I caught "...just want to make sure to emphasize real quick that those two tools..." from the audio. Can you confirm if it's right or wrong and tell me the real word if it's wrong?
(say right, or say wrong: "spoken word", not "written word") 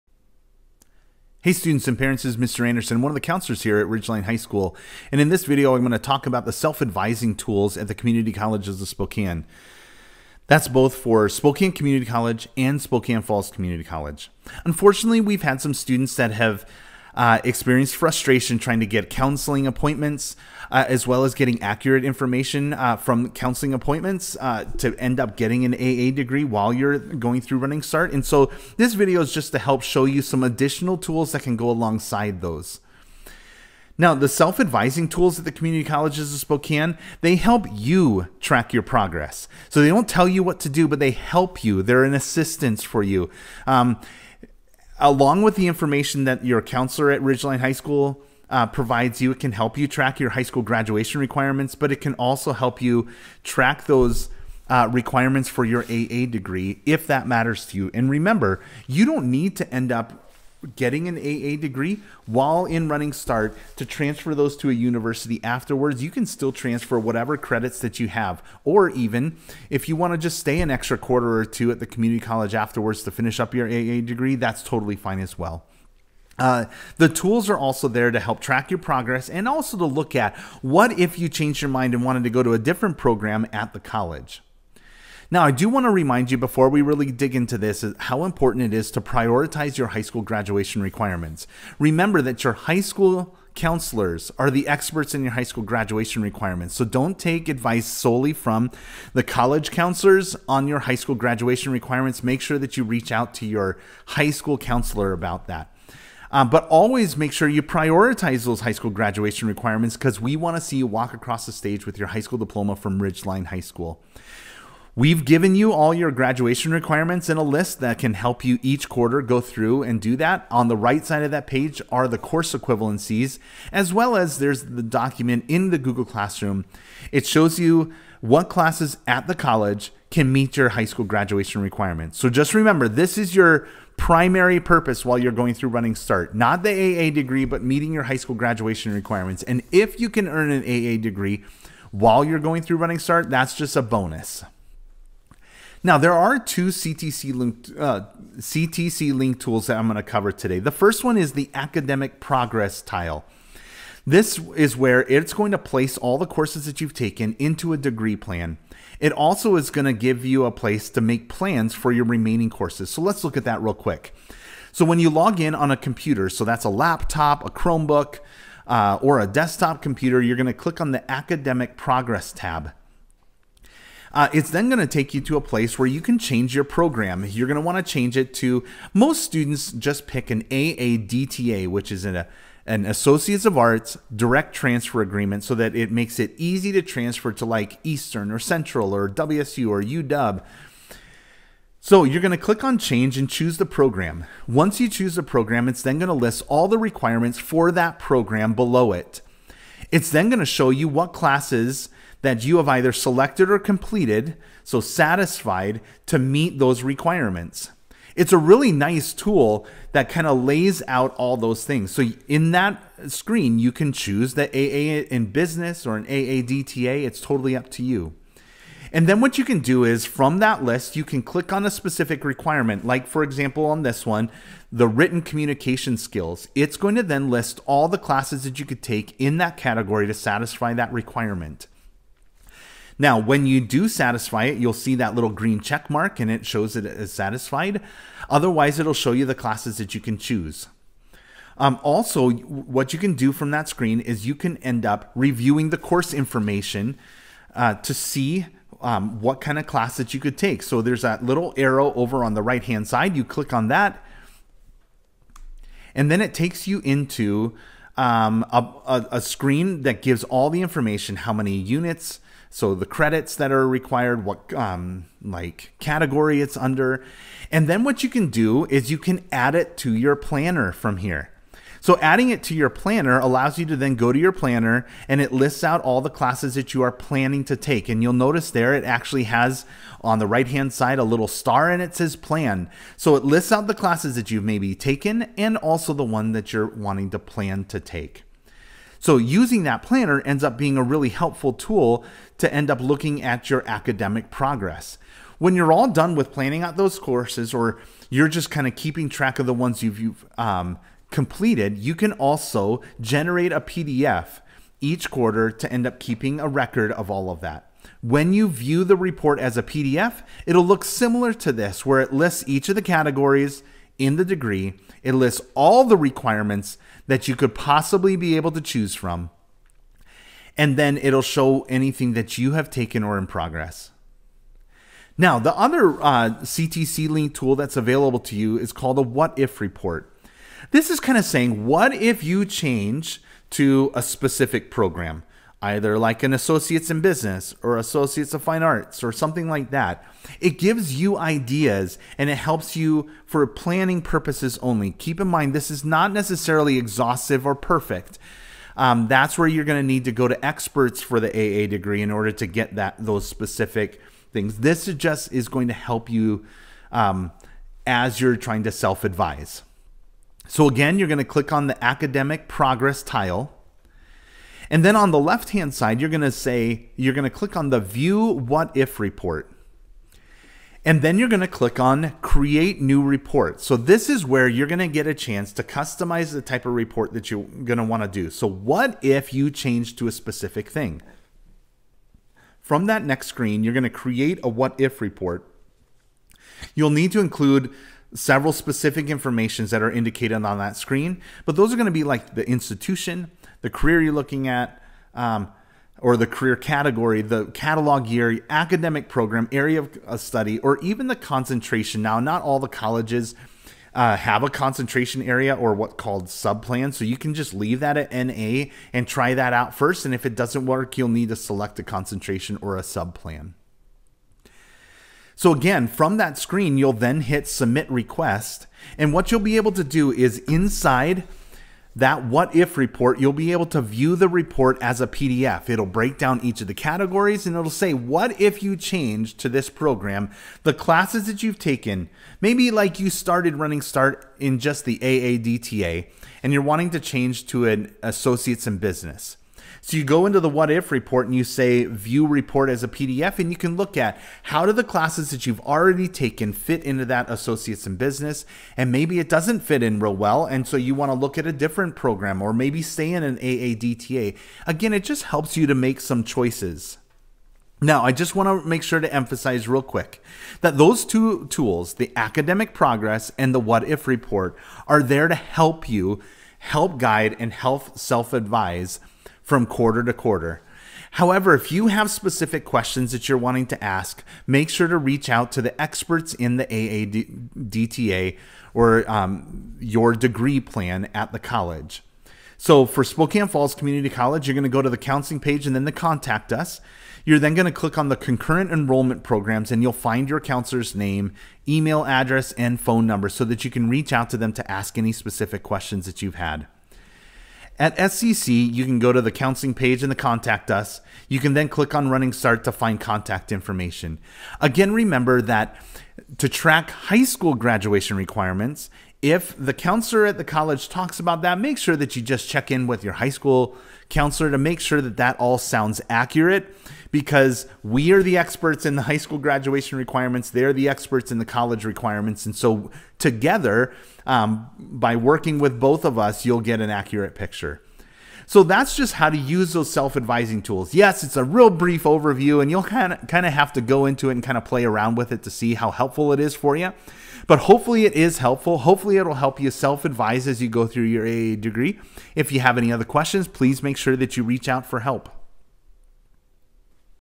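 right.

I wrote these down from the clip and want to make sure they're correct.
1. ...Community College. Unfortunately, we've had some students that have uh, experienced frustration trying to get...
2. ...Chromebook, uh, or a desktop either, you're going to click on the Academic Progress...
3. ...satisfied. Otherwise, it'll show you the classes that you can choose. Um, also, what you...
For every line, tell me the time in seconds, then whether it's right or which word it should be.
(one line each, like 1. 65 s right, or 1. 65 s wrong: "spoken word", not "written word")
1. 13 s right
2. 167 s wrong: "computer", not "either"
3. 237 s right.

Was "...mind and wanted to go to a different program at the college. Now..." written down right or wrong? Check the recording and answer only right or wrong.
right.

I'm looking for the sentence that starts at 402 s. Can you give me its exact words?
Now, not all the colleges uh, have a concentration area or what called subplan.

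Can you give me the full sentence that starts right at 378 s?
So what if you change to a specific thing?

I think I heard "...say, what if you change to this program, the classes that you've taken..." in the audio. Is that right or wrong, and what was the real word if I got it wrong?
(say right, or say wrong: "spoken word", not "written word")
right.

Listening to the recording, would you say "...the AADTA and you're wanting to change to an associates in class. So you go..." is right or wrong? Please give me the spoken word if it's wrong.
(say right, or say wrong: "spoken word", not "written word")
wrong: "business", not "class".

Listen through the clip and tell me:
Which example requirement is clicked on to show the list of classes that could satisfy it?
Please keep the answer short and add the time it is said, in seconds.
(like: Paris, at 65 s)
written communication skills, at 224 s.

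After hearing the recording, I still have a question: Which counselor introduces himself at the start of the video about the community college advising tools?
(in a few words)
Mr. Anderson.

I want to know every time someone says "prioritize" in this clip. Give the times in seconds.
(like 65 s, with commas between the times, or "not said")
88 s, 107 s.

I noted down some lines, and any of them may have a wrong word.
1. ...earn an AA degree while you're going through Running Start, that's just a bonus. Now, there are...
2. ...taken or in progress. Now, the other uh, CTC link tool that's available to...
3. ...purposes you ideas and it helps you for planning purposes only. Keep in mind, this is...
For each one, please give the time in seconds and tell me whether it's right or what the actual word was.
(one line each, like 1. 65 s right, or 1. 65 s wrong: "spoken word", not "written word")
1. 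140 s right
2. 322 s right
3. 340 s wrong: "gives", not "purposes".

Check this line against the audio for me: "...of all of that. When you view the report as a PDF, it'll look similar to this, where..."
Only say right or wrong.
right.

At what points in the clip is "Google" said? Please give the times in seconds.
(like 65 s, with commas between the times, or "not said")
125 s.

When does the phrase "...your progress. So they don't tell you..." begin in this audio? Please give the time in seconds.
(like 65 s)
38 s.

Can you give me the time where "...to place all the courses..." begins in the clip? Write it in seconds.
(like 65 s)
155 s.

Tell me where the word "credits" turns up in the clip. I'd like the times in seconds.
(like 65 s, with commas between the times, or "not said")
67 s, 262 s.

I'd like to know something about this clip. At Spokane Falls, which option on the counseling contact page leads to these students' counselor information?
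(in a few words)
concurrent enrollment programs.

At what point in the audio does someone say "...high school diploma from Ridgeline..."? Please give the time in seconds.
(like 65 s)
112 s.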